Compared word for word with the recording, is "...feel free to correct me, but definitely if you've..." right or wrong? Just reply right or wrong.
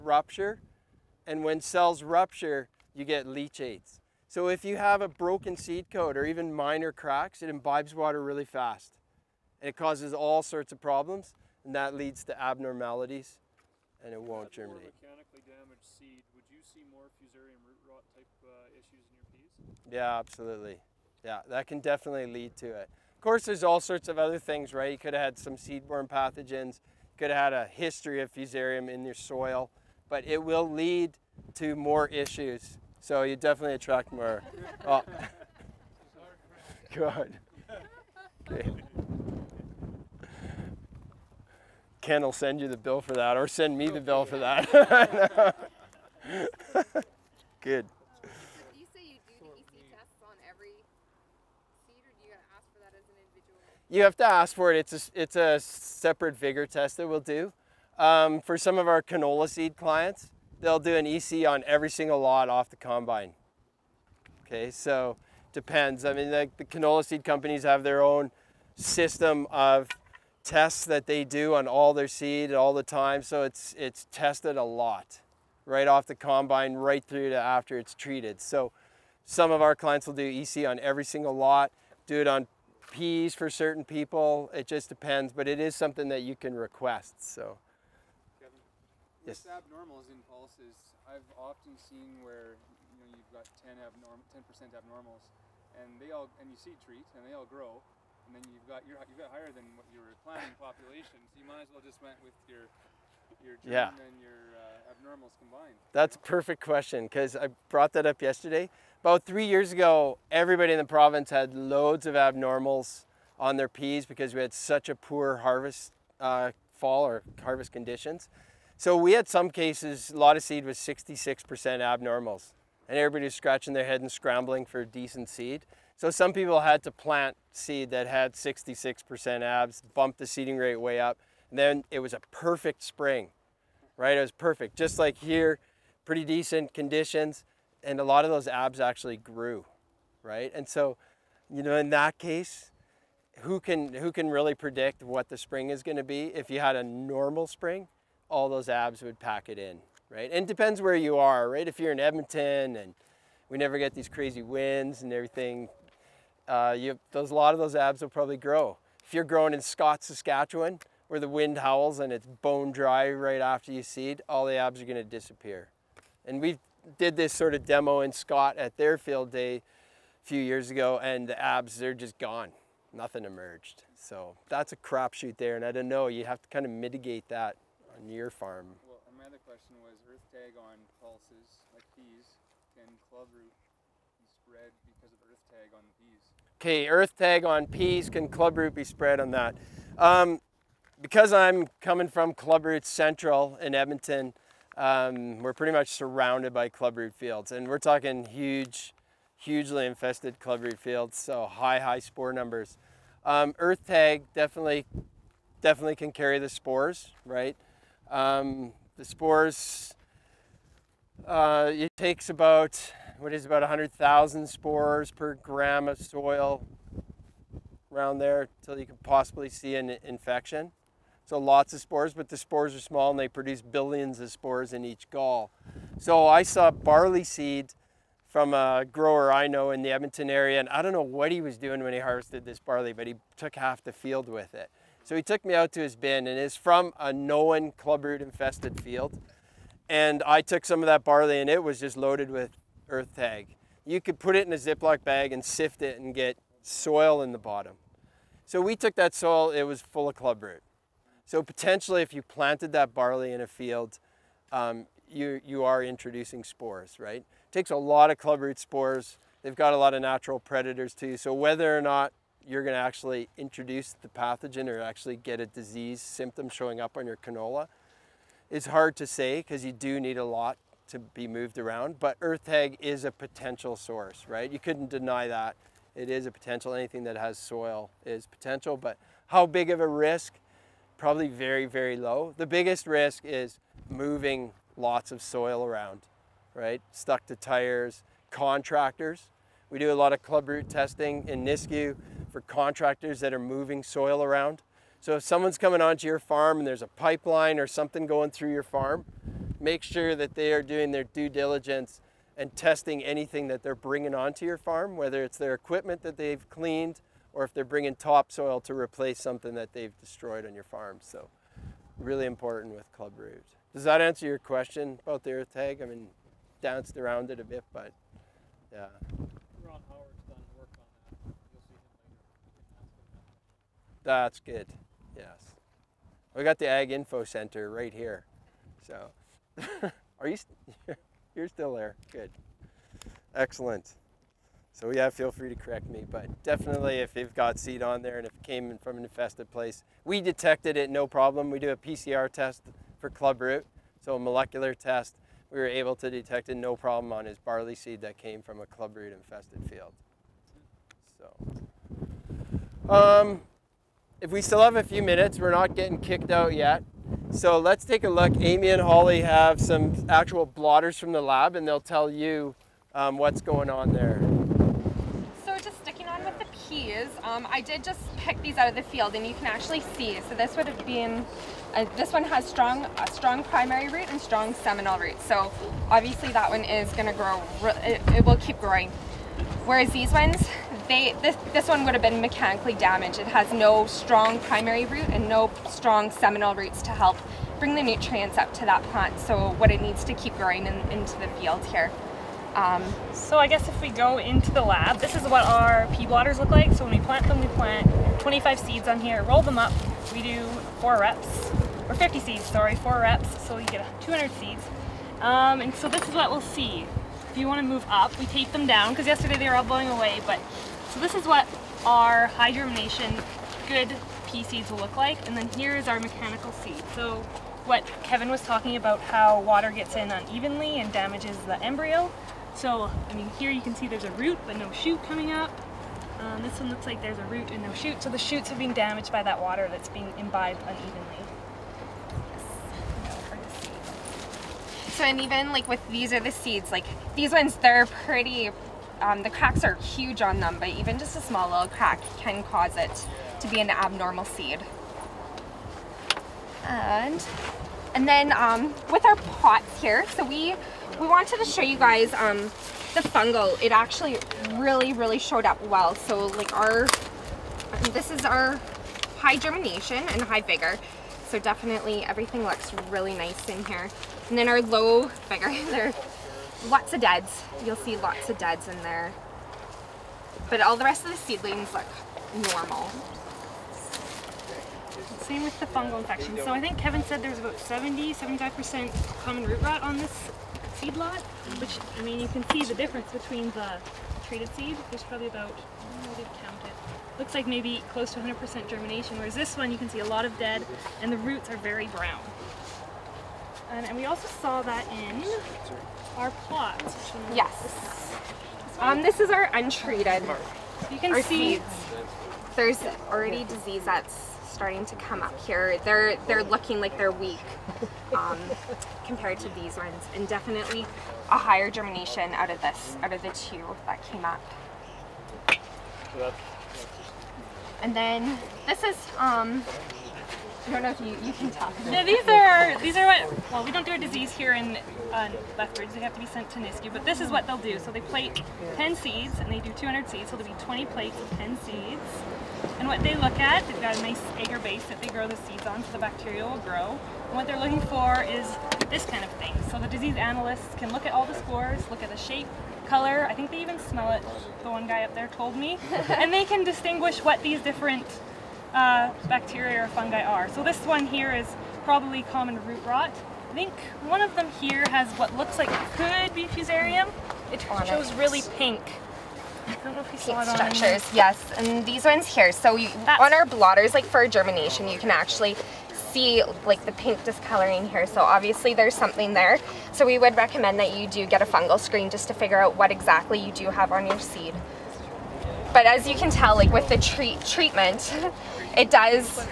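right.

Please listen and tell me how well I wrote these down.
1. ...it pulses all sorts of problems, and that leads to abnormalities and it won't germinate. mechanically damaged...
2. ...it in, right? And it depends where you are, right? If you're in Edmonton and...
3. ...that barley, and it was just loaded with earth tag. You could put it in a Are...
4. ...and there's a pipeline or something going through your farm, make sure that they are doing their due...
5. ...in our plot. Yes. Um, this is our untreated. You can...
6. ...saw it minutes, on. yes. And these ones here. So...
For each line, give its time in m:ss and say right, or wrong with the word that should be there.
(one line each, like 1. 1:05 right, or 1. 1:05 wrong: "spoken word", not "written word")
1. 0:09 wrong: "causes", not "pulses"
2. 2:29 right
3. 4:00 wrong: "Ziploc", not "Are"
4. 4:56 right
5. 8:14 right
6. 9:20 wrong: "structures", not "minutes".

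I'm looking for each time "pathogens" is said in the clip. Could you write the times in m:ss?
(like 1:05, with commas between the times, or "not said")
0:26, 4:24.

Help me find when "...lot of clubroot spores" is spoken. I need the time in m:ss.
4:17.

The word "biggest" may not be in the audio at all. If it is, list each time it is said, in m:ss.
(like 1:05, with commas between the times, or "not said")
4:42.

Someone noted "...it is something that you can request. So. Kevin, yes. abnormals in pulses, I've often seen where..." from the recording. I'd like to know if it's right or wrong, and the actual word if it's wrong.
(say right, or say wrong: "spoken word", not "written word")
right.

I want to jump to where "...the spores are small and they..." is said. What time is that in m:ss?
3:42.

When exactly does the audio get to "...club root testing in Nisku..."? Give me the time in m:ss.
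4:50.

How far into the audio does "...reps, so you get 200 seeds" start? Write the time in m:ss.
6:42.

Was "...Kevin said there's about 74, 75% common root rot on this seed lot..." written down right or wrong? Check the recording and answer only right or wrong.
wrong.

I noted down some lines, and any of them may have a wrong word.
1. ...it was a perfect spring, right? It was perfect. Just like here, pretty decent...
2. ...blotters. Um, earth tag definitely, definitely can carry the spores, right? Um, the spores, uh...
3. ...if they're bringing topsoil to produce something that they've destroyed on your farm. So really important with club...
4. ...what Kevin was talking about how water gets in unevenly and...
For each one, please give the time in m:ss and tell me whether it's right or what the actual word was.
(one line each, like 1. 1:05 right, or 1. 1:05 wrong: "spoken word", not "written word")
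1. 2:11 right
2. 3:22 wrong: "numbers", not "blotters"
3. 5:07 wrong: "replace", not "produce"
4. 6:57 right.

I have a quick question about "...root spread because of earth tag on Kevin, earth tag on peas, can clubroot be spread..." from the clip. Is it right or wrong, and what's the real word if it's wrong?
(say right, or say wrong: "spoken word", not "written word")
wrong: "Okay", not "Kevin".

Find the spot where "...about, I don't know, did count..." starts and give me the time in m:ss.
8:05.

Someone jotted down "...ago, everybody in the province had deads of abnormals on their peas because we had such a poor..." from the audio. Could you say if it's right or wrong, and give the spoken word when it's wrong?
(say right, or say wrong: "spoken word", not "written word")
wrong: "loads", not "deads".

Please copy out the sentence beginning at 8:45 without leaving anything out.
They have to be sent to Nisku, but this is what they'll do.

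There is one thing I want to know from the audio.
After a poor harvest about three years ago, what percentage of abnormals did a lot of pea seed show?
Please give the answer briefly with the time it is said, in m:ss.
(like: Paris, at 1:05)
66%, at 2:00.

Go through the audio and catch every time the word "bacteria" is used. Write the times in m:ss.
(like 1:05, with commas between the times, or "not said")
8:55, 9:09.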